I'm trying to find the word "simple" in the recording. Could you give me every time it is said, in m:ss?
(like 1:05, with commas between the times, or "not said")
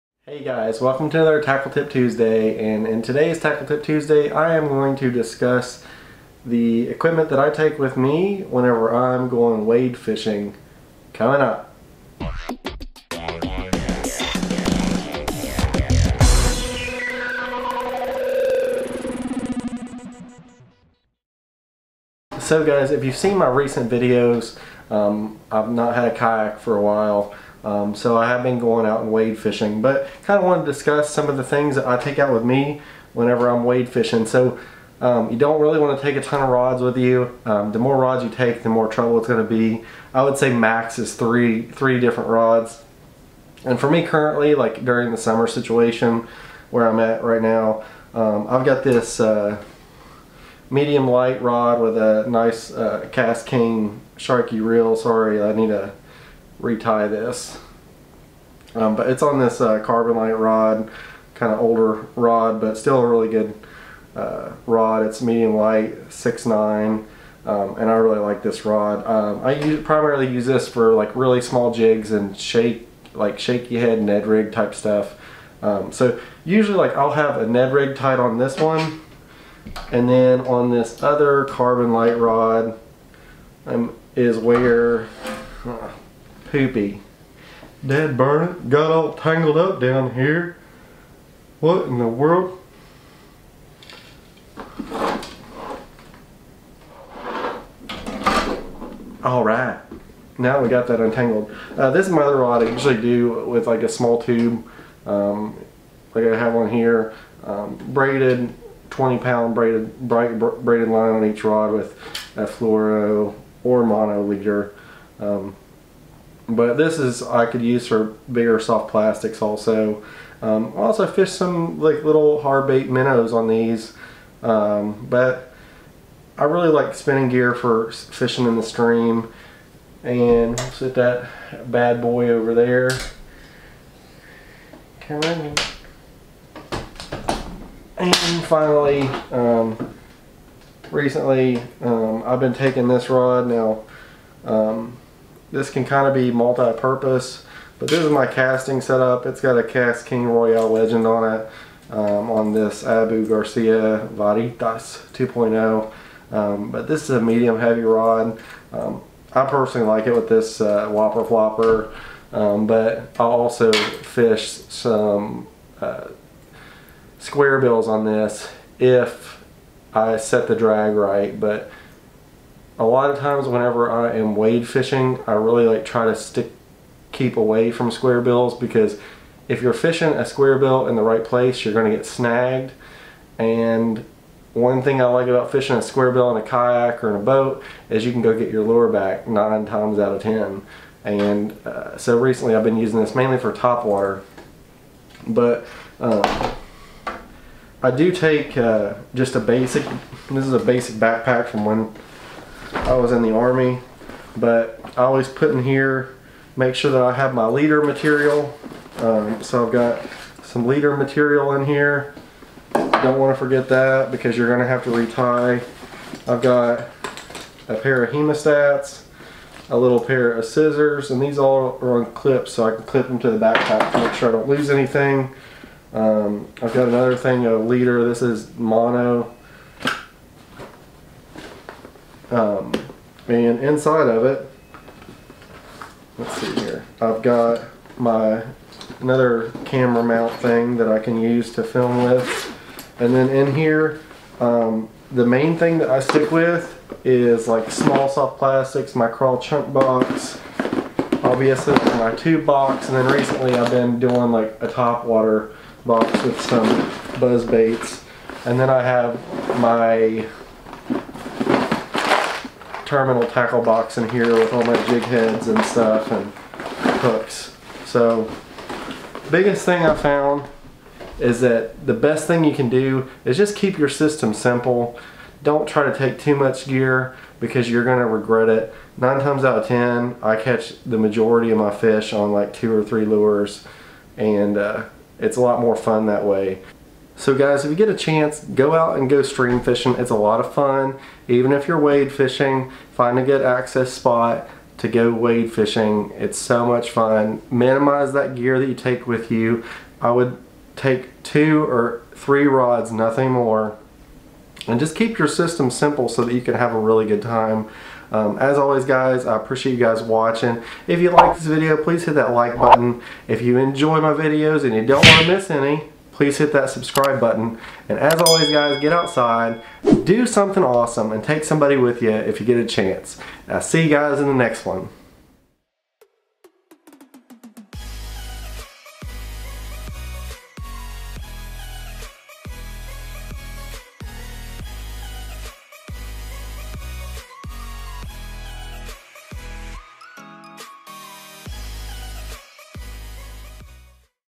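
4:34, 5:05.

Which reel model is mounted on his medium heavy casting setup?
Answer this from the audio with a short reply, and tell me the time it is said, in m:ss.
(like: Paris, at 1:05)
KastKing Royale Legend, at 2:29.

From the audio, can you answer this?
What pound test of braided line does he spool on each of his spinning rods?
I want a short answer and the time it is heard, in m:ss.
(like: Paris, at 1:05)
20 pound, at 1:48.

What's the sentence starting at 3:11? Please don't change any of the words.
And uh, so recently I've been using this mainly for top water.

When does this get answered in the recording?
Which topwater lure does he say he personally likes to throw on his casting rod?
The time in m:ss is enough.
2:40.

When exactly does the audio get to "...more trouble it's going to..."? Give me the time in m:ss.
0:38.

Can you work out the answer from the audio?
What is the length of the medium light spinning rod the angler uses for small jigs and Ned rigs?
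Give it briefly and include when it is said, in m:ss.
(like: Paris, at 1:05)
6'9", at 1:06.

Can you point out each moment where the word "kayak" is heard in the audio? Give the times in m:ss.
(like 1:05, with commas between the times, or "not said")
0:26, 3:06.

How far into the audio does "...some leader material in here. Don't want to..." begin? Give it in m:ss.
3:30.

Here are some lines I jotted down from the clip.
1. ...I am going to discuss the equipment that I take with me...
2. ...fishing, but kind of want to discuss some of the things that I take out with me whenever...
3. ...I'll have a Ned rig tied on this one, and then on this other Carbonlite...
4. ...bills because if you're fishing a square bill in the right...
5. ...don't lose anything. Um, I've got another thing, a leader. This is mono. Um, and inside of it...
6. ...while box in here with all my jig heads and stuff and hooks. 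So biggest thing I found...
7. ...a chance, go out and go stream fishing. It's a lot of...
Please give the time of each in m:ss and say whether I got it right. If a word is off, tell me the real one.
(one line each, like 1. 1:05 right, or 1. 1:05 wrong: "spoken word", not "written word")
1. 0:04 right
2. 0:29 right
3. 1:16 right
4. 2:58 right
5. 3:44 right
6. 4:23 wrong: "tackle", not "while"
7. 4:47 right.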